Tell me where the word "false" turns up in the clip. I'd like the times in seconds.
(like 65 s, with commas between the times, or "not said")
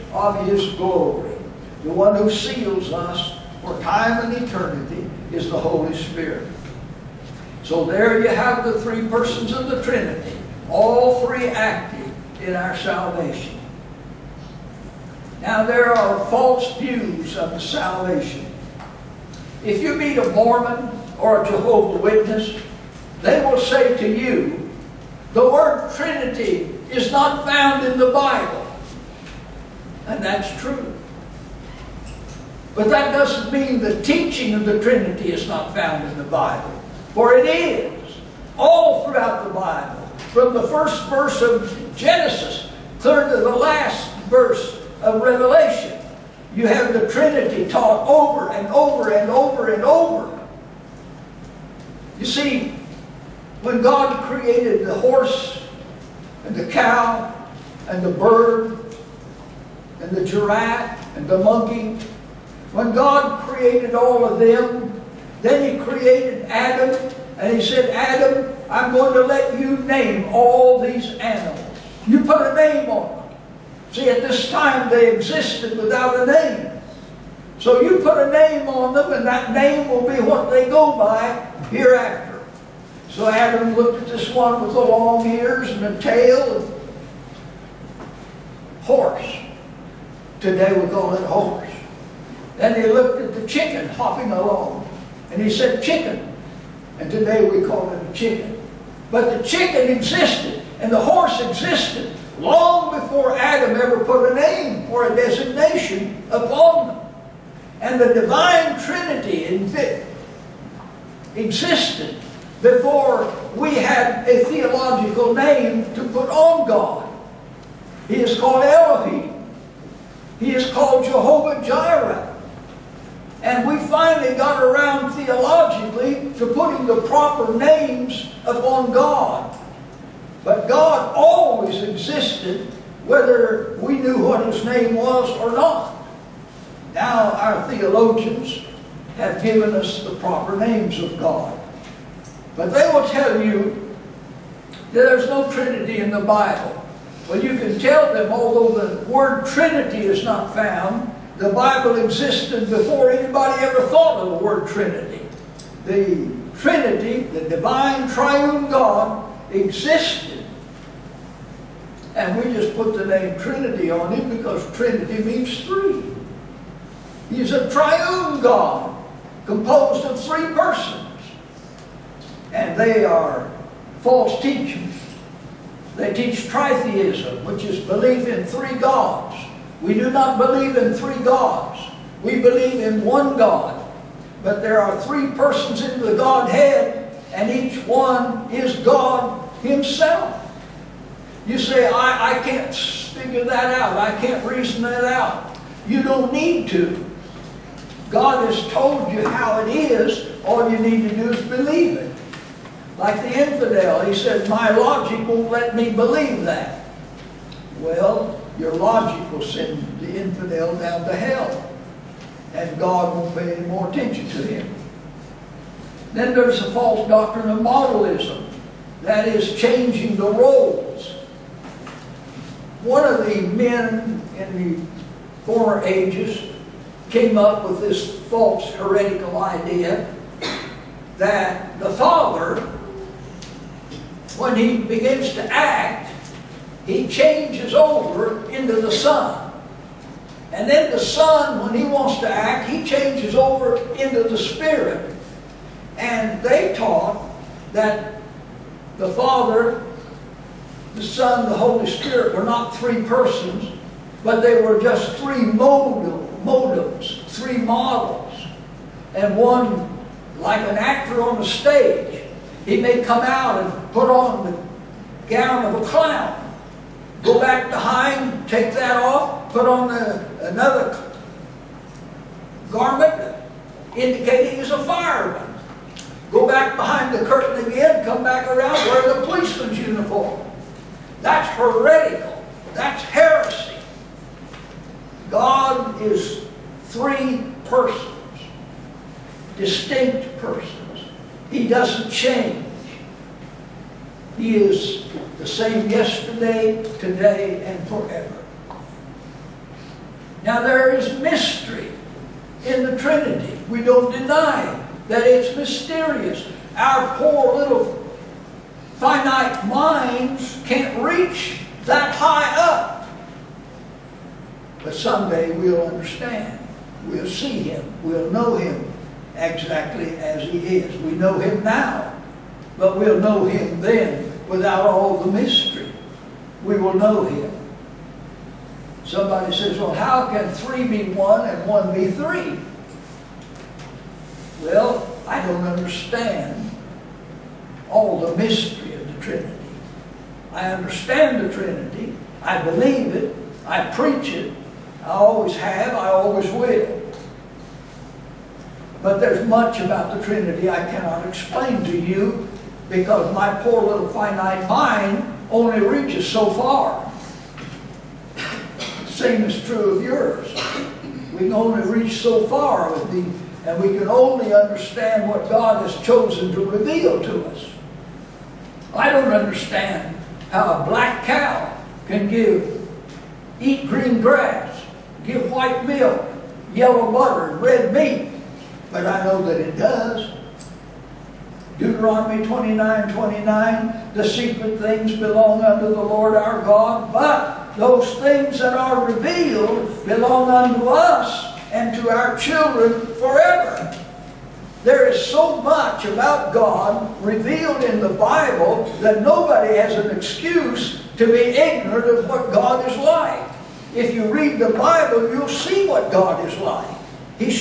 16 s, 174 s, 216 s, 228 s.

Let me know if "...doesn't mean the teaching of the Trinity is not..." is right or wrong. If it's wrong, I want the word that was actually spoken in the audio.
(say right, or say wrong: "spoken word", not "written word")
right.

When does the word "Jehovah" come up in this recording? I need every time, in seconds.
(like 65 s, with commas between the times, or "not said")
21 s, 121 s.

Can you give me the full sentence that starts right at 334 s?
Well, I don't understand all the mystery of the Trinity.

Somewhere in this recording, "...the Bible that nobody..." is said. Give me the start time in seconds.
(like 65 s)
398 s.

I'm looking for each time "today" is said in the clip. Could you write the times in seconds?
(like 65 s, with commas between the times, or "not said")
90 s, 97 s, 296 s.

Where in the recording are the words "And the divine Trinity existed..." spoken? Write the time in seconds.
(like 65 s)
107 s.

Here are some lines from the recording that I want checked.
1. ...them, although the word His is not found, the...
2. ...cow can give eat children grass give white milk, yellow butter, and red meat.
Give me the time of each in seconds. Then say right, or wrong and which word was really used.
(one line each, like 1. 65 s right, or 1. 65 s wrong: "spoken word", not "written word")
1. 148 s wrong: "Trinity", not "His"
2. 371 s wrong: "green", not "children".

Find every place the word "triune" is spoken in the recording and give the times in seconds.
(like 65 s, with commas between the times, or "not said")
158 s, 167 s.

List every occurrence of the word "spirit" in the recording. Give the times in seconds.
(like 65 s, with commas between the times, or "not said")
5 s, 244 s, 251 s.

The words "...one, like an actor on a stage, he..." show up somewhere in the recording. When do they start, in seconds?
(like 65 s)
259 s.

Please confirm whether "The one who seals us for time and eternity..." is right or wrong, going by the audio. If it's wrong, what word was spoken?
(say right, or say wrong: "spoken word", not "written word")
right.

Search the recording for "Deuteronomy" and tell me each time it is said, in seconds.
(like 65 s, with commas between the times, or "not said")
381 s.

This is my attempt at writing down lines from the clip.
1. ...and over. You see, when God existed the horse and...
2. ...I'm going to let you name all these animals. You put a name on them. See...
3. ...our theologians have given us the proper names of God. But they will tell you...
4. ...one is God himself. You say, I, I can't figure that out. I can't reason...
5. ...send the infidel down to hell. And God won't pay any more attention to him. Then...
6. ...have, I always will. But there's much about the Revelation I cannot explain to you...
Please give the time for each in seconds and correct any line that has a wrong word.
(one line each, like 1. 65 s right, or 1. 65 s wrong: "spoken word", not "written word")
1. 49 s wrong: "created", not "existed"
2. 68 s right
3. 137 s right
4. 187 s right
5. 209 s right
6. 345 s wrong: "Trinity", not "Revelation".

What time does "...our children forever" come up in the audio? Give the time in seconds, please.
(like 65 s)
392 s.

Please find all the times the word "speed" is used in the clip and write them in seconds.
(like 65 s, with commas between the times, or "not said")
not said.